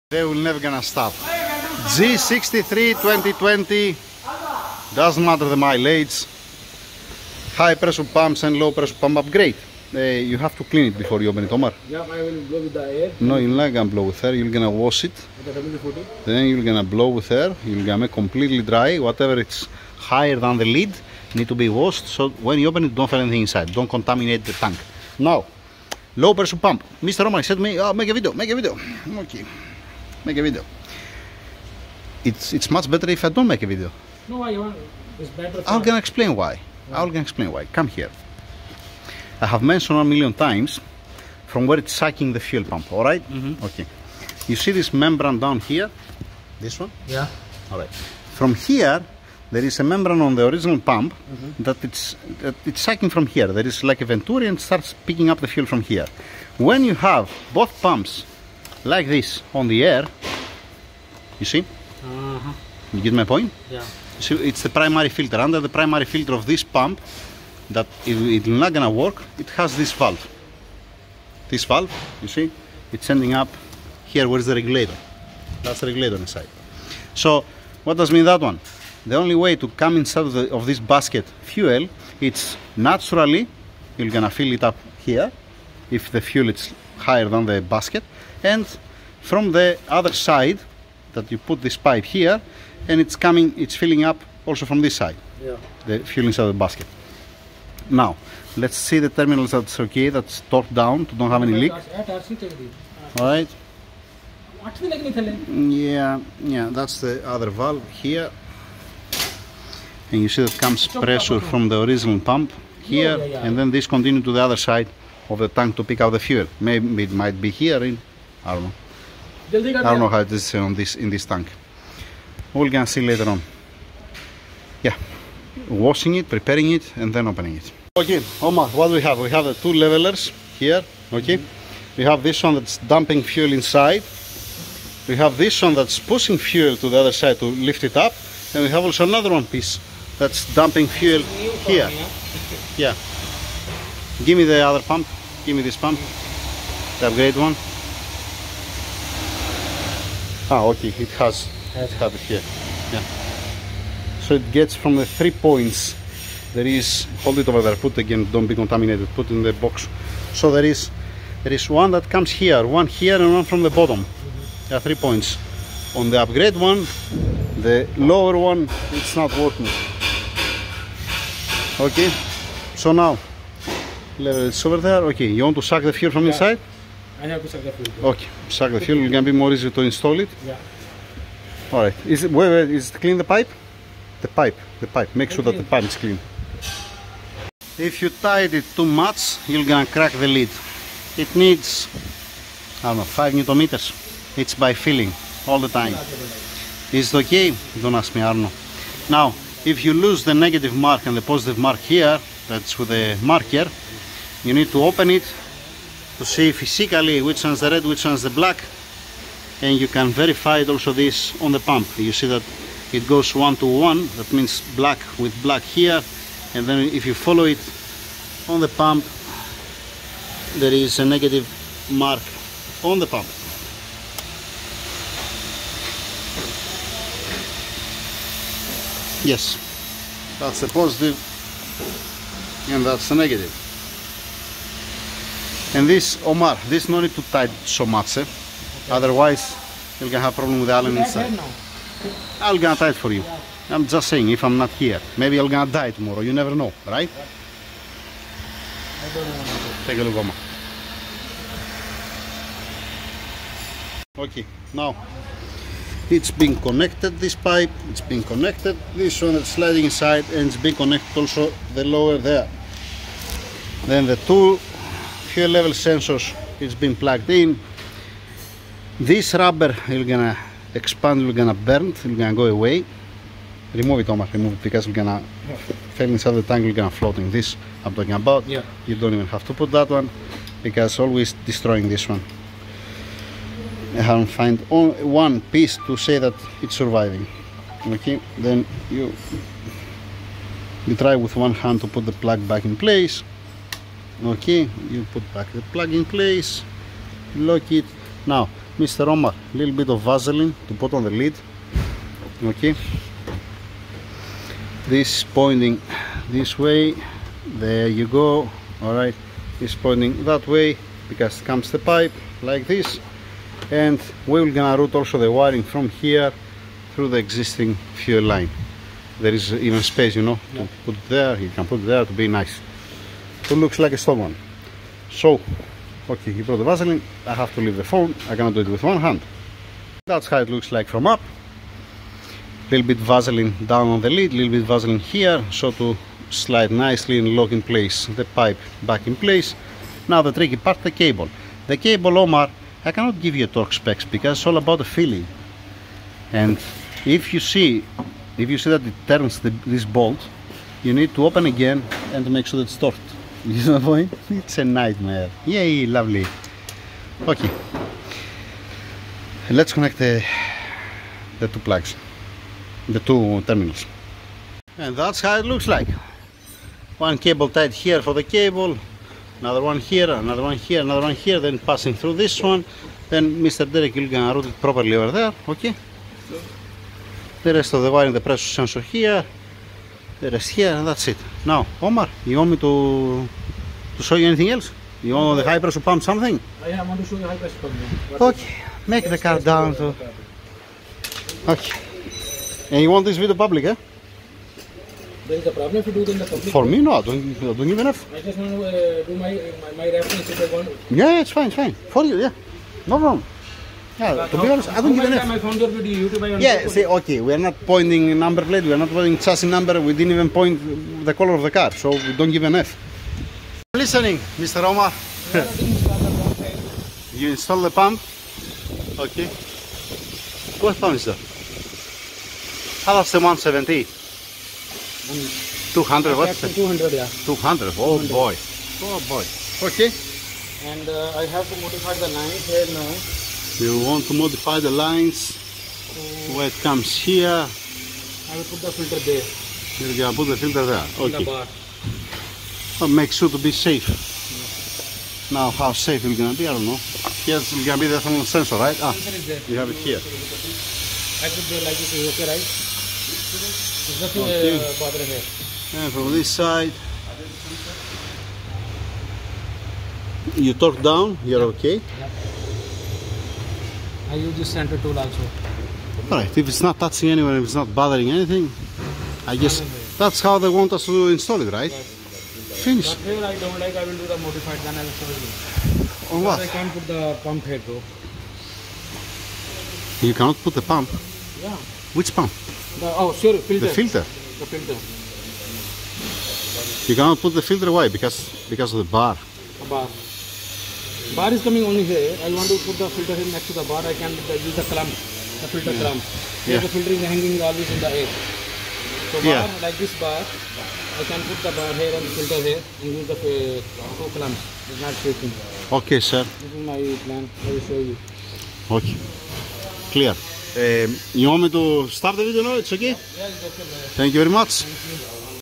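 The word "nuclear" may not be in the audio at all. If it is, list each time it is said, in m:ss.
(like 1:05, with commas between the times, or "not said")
not said.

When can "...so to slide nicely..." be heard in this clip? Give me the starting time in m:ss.
5:35.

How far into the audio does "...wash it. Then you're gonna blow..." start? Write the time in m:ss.
0:14.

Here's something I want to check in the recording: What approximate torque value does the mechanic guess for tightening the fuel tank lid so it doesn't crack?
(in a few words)
5 newton meters.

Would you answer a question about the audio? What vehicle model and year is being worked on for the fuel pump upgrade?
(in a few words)
G63 2020.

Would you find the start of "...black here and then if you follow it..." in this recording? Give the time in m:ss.
3:35.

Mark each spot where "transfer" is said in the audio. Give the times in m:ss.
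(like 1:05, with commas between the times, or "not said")
not said.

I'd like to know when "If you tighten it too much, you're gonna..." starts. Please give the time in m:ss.
3:07.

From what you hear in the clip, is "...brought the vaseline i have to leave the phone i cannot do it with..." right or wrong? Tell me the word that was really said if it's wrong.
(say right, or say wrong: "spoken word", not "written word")
right.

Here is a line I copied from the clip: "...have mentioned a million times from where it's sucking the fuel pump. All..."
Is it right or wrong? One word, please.
right.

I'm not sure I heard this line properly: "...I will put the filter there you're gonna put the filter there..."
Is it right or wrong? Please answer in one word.
right.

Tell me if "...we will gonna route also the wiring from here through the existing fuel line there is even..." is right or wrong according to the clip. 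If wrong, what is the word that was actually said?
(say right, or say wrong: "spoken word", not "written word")
right.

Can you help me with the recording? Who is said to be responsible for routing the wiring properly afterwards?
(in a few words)
Derek.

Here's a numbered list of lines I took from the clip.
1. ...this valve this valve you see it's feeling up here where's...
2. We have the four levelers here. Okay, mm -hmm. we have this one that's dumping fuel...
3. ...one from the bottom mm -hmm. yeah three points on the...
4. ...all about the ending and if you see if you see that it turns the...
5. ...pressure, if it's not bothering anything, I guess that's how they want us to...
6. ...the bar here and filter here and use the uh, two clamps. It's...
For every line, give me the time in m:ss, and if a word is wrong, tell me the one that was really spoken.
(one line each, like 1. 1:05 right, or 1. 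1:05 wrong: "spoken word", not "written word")
1. 1:09 wrong: "ending", not "feeling"
2. 2:09 wrong: "two", not "four"
3. 2:43 right
4. 5:44 wrong: "feeling", not "ending"
5. 7:47 wrong: "anywhere", not "pressure"
6. 8:21 right.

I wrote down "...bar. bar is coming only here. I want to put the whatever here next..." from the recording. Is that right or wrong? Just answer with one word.
wrong.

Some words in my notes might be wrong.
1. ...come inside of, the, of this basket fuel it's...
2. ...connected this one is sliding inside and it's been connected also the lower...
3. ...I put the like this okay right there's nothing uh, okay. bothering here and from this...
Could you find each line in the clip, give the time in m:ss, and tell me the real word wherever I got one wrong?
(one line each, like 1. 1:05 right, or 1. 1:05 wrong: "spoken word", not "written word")
1. 1:19 right
2. 4:18 right
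3. 7:31 right.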